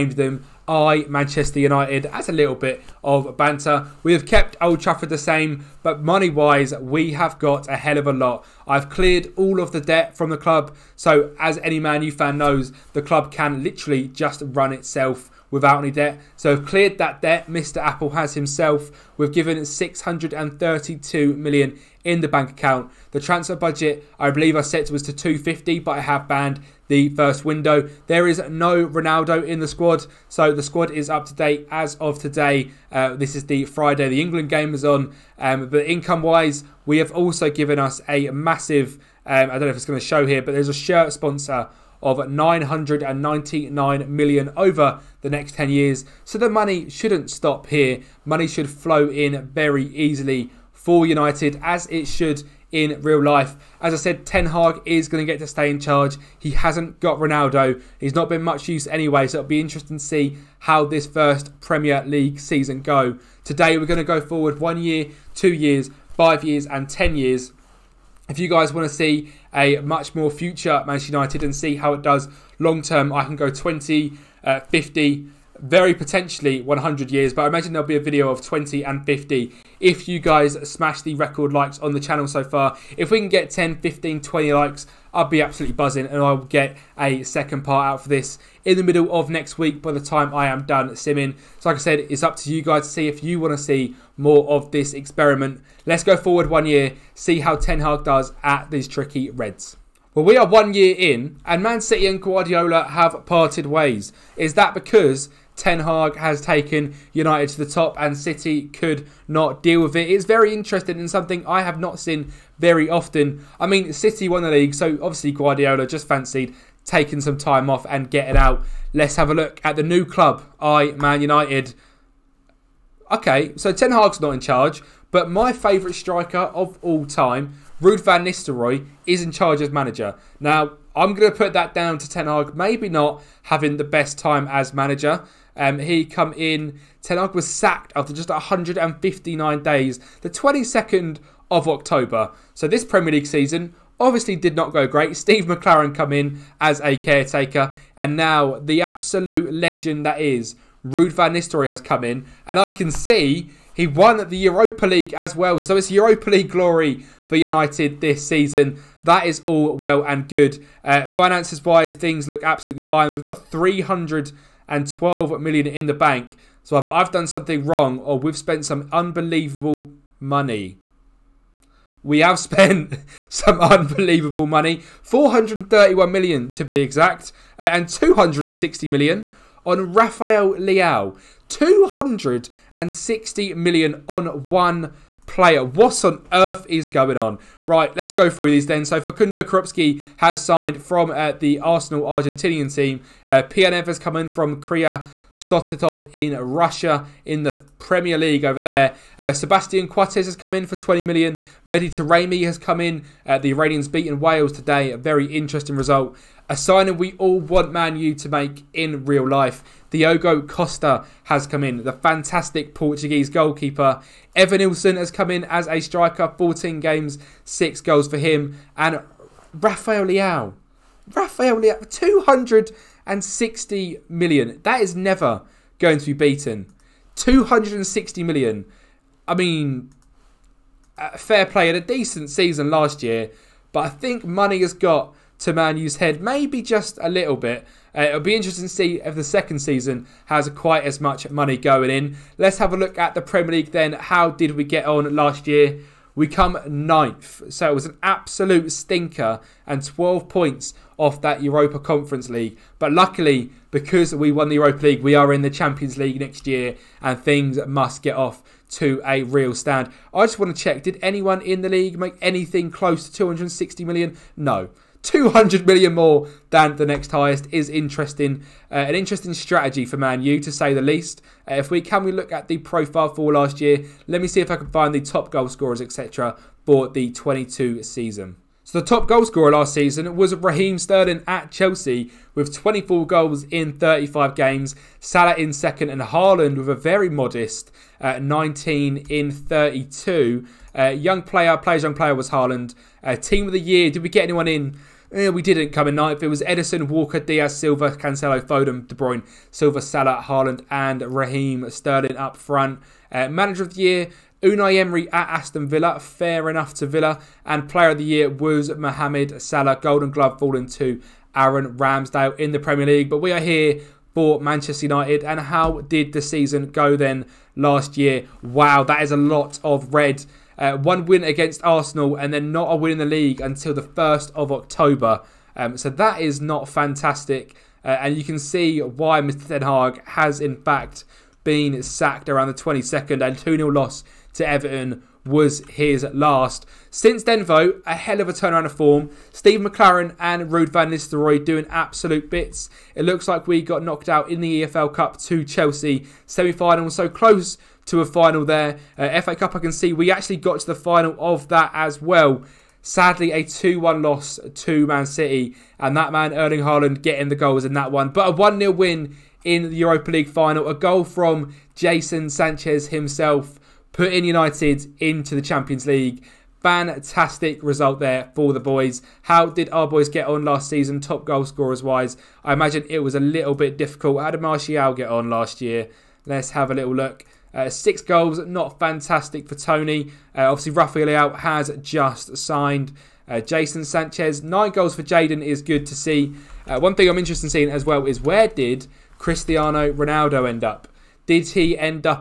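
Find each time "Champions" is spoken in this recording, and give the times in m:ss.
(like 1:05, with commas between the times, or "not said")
4:15, 6:05.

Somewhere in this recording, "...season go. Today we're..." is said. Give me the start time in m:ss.
1:02.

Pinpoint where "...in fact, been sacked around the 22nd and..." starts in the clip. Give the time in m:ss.
5:30.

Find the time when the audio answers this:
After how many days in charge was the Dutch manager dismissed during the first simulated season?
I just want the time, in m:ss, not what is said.
2:18.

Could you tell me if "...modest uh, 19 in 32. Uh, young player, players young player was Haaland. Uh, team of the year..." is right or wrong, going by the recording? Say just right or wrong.
right.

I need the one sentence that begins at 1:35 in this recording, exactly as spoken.
Let's go forward one year, see how Ten Hag does at these tricky Reds.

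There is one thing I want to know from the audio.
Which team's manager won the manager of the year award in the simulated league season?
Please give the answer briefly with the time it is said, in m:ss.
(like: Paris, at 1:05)
Aston Villa, at 5:05.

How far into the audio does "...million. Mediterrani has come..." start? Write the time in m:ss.
3:21.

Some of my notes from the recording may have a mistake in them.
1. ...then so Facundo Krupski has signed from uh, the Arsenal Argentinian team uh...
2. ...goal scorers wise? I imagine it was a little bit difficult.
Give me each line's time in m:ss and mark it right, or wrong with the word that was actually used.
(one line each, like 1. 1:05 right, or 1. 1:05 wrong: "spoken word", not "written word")
1. 3:08 right
2. 6:11 right.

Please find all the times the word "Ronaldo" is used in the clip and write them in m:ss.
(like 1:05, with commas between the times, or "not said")
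0:28, 0:57, 6:29.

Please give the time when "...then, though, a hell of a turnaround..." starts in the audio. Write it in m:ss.
5:37.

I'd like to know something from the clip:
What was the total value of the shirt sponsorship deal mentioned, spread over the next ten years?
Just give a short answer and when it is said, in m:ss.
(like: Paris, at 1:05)
999 million, at 0:42.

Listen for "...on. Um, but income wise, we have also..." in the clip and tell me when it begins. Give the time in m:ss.
0:34.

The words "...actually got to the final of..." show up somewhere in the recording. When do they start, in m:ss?
5:50.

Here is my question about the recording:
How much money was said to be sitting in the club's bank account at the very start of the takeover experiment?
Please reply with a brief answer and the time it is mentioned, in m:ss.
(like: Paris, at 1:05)
632 million, at 0:19.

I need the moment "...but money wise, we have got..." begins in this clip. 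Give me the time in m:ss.
0:05.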